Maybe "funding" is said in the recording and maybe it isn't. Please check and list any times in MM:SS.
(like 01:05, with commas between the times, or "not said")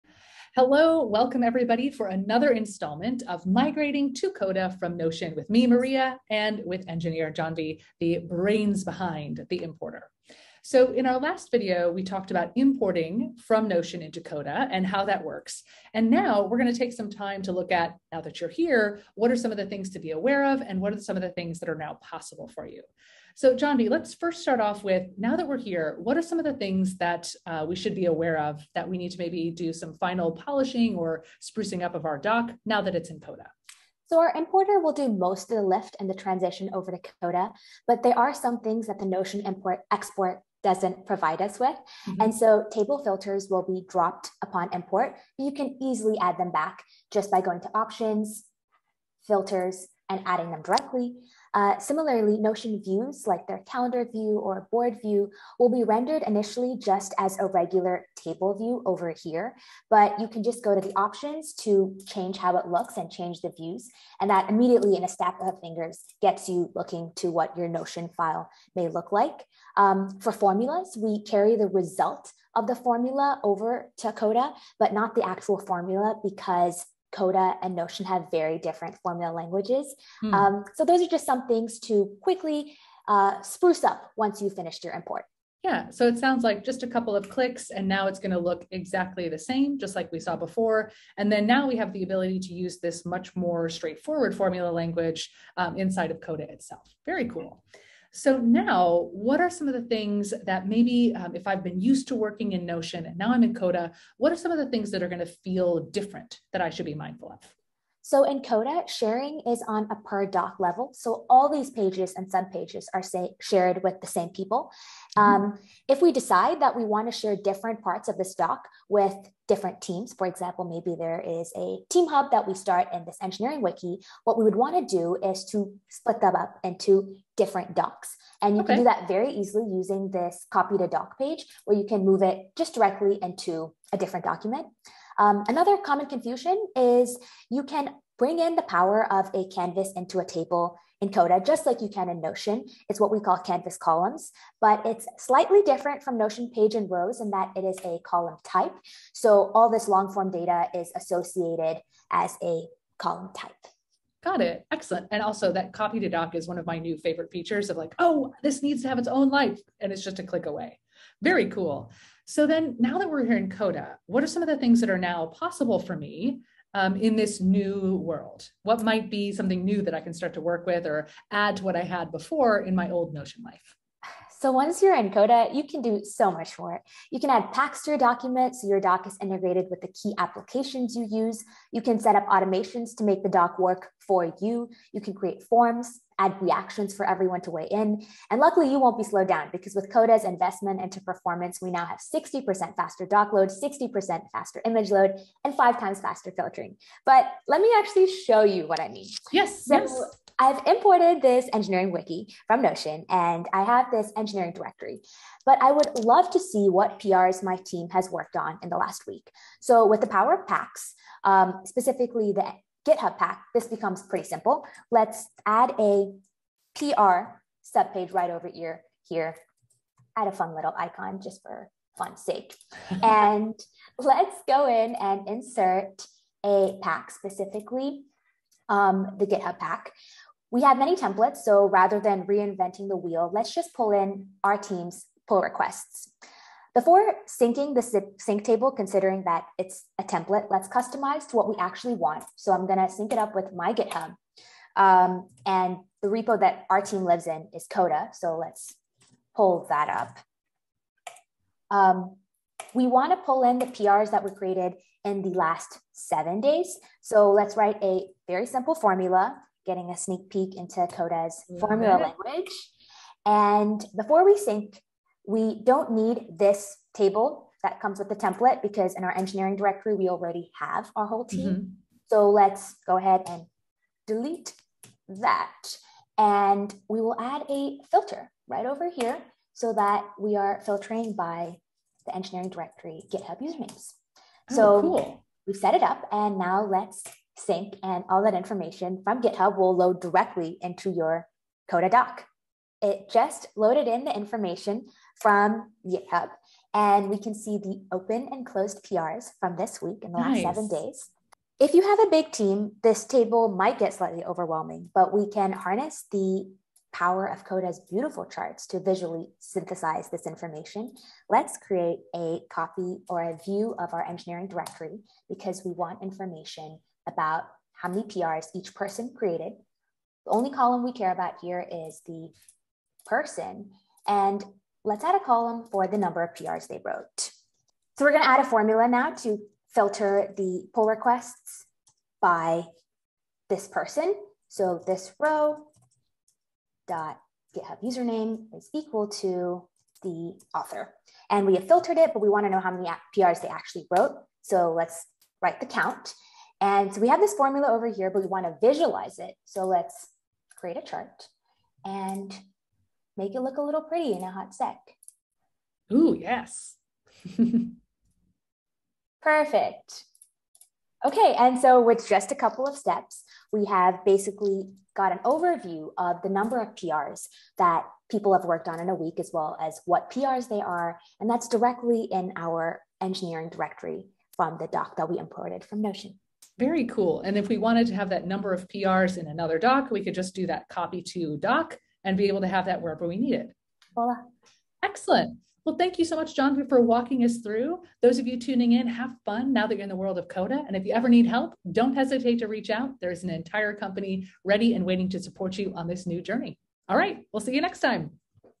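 not said.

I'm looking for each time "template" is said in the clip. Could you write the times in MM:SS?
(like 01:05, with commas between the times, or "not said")
03:50, 04:00, 04:28.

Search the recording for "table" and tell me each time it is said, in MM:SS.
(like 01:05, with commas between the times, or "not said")
00:42, 00:58, 02:20, 03:58, 04:26, 05:03.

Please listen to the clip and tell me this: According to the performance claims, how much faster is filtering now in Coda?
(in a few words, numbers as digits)
5 times faster.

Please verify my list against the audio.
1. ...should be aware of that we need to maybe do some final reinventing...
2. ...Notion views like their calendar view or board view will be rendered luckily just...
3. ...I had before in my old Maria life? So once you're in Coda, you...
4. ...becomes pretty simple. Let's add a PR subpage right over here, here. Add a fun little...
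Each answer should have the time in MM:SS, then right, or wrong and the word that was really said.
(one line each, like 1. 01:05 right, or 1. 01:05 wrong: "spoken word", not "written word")
1. 00:27 wrong: "polishing", not "reinventing"
2. 00:52 wrong: "initially", not "luckily"
3. 02:51 wrong: "Notion", not "Maria"
4. 03:33 right.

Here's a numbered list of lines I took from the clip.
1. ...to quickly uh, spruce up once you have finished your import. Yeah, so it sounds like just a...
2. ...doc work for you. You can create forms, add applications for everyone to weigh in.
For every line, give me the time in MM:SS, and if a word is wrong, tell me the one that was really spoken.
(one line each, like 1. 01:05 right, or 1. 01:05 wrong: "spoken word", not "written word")
1. 01:21 right
2. 03:03 wrong: "reactions", not "applications".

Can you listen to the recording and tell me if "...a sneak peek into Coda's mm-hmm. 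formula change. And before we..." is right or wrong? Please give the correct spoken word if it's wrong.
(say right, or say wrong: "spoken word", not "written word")
wrong: "language", not "change".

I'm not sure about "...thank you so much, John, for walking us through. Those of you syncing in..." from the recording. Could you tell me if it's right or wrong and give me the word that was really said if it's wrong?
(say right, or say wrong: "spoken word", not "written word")
wrong: "tuning", not "syncing".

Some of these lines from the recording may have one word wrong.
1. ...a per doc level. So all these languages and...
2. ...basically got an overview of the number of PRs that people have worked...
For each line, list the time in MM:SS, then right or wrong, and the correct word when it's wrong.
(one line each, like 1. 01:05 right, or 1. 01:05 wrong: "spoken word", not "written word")
1. 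01:49 wrong: "pages", not "languages"
2. 06:04 right.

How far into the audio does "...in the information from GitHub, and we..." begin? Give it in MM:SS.
04:53.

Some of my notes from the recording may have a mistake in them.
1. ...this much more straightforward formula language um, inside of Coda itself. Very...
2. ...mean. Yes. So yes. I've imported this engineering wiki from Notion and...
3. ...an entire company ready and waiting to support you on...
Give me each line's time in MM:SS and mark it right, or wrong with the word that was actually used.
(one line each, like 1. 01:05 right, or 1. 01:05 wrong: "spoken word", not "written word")
1. 01:32 right
2. 03:18 right
3. 06:33 right.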